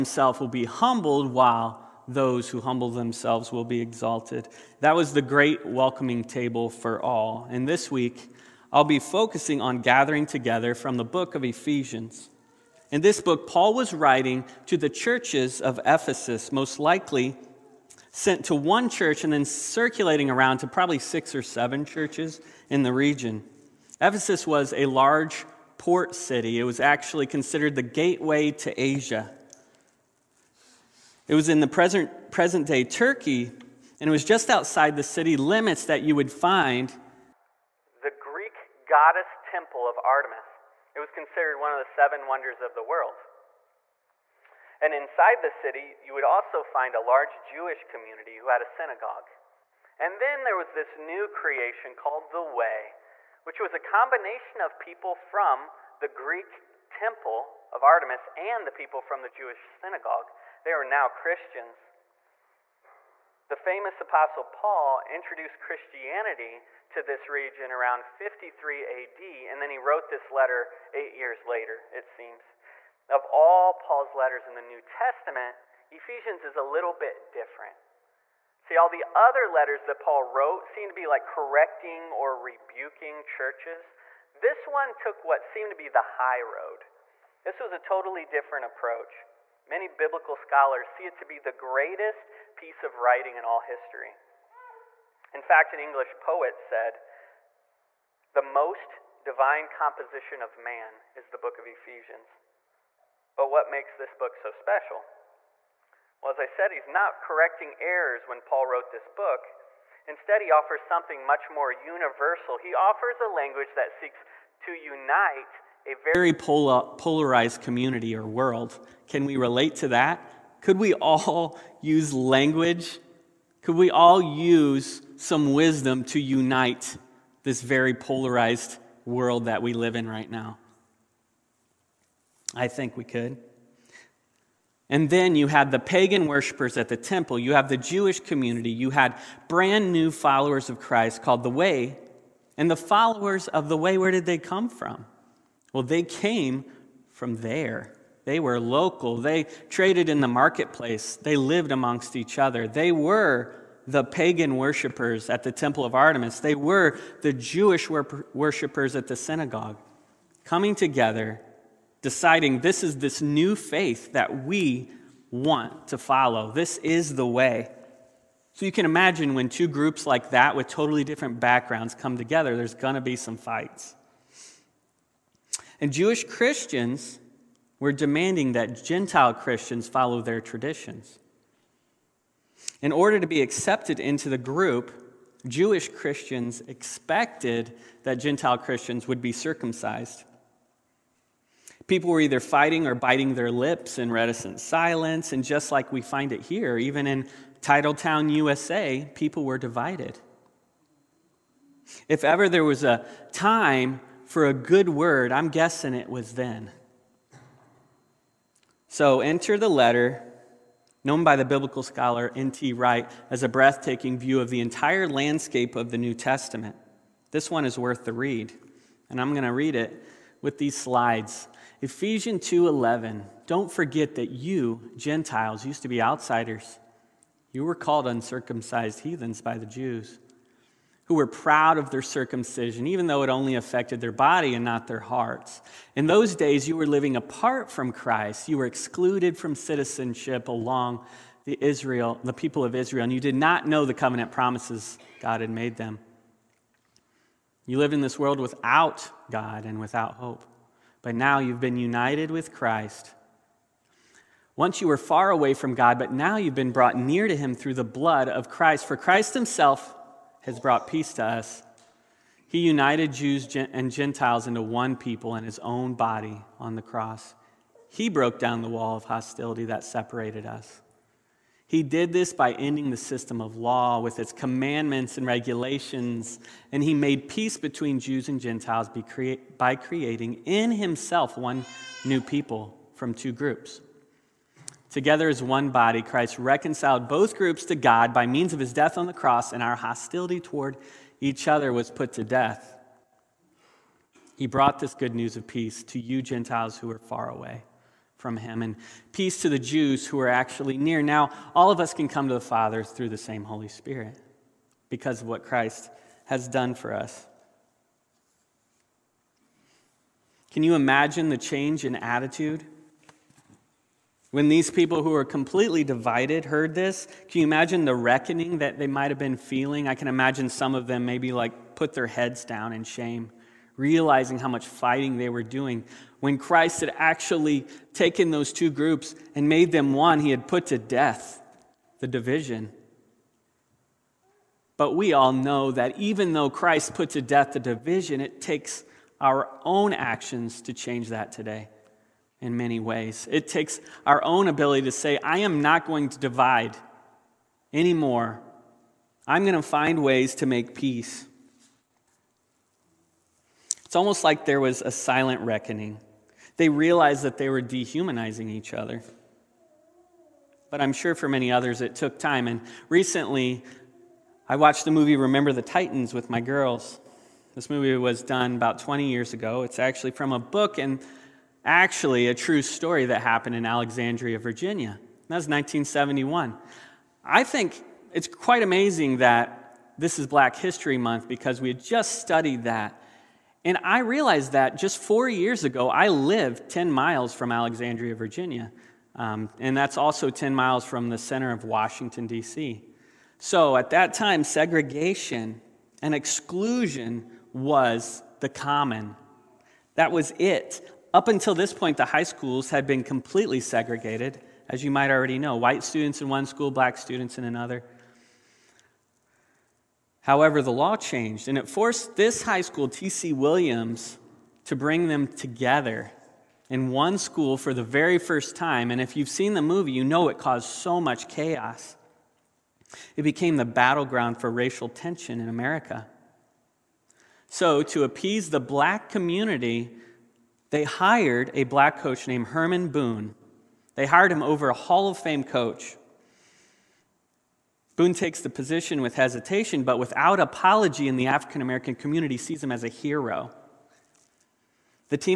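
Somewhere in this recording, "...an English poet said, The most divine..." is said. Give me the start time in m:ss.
1:35.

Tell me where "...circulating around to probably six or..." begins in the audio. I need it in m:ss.
0:19.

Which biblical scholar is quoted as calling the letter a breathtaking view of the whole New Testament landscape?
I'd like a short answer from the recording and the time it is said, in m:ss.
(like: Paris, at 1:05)
N.T. Wright, at 3:32.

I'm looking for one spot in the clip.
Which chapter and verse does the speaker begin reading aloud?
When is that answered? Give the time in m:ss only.
3:41.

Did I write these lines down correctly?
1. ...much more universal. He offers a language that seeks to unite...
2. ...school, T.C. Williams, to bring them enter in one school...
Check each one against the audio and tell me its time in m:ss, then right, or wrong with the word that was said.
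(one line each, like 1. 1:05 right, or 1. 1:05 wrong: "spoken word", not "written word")
1. 1:51 right
2. 6:52 wrong: "together", not "enter".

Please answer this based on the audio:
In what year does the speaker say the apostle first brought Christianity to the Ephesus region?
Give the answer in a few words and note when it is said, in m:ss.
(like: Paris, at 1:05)
53 AD, at 1:08.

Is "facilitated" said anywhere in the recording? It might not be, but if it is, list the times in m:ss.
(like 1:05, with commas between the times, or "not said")
not said.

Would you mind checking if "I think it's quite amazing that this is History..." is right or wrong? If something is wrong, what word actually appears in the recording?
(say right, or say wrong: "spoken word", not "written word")
wrong: "Black", not "History".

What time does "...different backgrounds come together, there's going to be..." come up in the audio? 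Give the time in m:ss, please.
2:51.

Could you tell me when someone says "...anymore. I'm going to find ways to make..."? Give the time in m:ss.
5:47.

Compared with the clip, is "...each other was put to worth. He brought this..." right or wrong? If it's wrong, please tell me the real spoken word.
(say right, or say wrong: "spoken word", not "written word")
wrong: "death", not "worth".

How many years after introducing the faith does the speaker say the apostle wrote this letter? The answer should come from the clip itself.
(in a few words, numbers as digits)
8.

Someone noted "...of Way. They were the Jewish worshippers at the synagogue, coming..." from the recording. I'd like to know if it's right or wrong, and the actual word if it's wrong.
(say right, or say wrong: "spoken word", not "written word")
wrong: "Artemis", not "Way".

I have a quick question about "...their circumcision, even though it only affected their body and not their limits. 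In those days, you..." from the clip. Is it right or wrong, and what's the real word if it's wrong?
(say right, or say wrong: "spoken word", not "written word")
wrong: "hearts", not "limits".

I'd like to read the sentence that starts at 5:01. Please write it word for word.
Now, all of us can come to the Father through the same Holy Spirit because of what Christ has done for us.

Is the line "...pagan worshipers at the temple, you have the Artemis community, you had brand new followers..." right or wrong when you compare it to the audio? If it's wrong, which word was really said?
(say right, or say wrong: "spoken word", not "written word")
wrong: "Jewish", not "Artemis".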